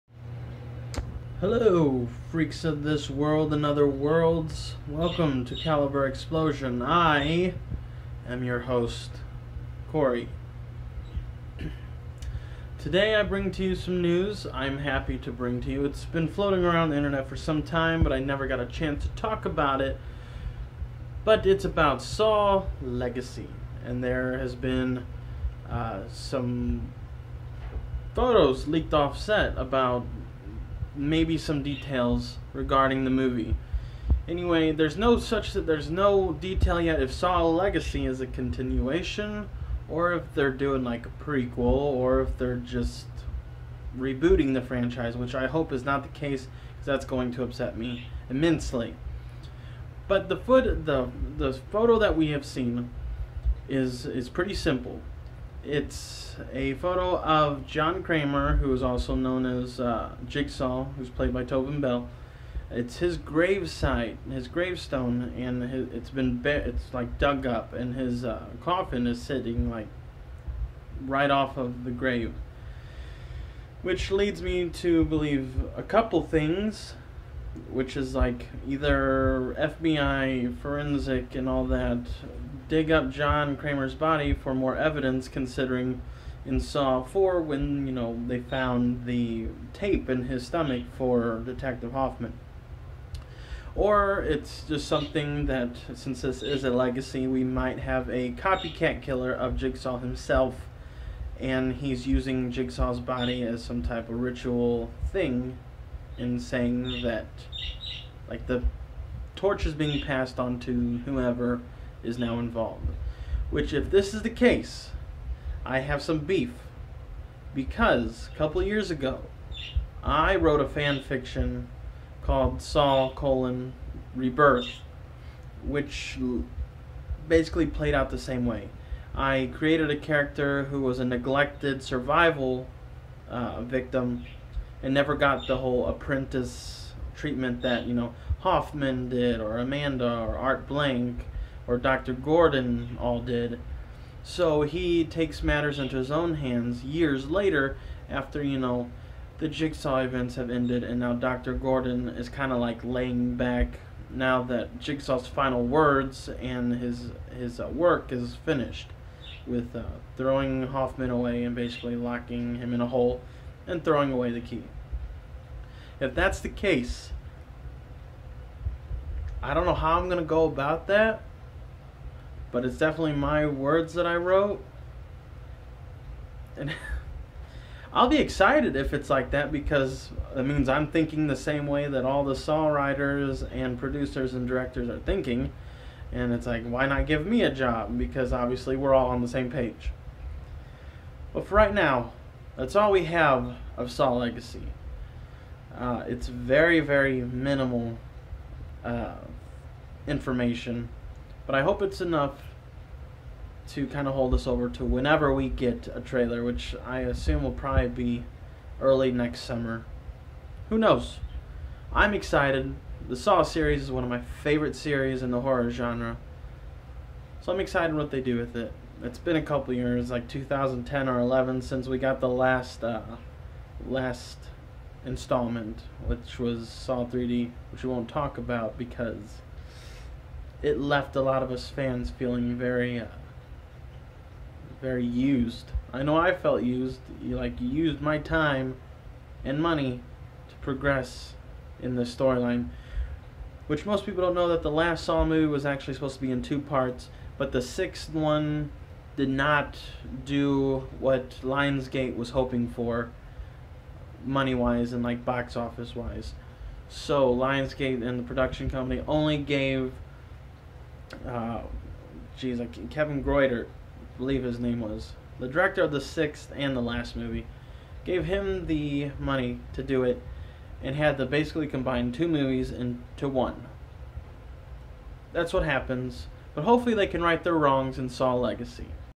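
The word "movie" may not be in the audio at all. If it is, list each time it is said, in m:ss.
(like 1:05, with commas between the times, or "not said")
0:33, 4:05, 4:27, 4:32.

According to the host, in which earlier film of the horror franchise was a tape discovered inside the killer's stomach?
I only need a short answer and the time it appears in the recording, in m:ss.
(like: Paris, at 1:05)
Saw 4, at 1:26.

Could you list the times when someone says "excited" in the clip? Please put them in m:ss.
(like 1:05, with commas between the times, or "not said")
2:58, 3:32, 3:37.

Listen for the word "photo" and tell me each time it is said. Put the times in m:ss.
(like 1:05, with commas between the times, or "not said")
0:28, 0:51, 0:56.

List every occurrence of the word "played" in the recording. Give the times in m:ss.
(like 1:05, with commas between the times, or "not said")
1:01, 2:07.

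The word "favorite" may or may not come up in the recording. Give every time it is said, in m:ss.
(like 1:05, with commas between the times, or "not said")
3:34.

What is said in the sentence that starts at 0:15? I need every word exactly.
It's been floating around the internet for some time, but I never got a chance to talk about it.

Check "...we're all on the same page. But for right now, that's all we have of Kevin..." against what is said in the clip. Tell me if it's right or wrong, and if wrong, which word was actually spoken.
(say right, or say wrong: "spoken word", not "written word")
wrong: "Saw", not "Kevin".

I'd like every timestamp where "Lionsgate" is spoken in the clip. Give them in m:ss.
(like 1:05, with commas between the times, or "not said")
4:11, 4:17.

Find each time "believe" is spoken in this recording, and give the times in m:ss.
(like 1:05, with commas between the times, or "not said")
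1:15, 4:24.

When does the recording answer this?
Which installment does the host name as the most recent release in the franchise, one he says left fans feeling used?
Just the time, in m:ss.
3:46.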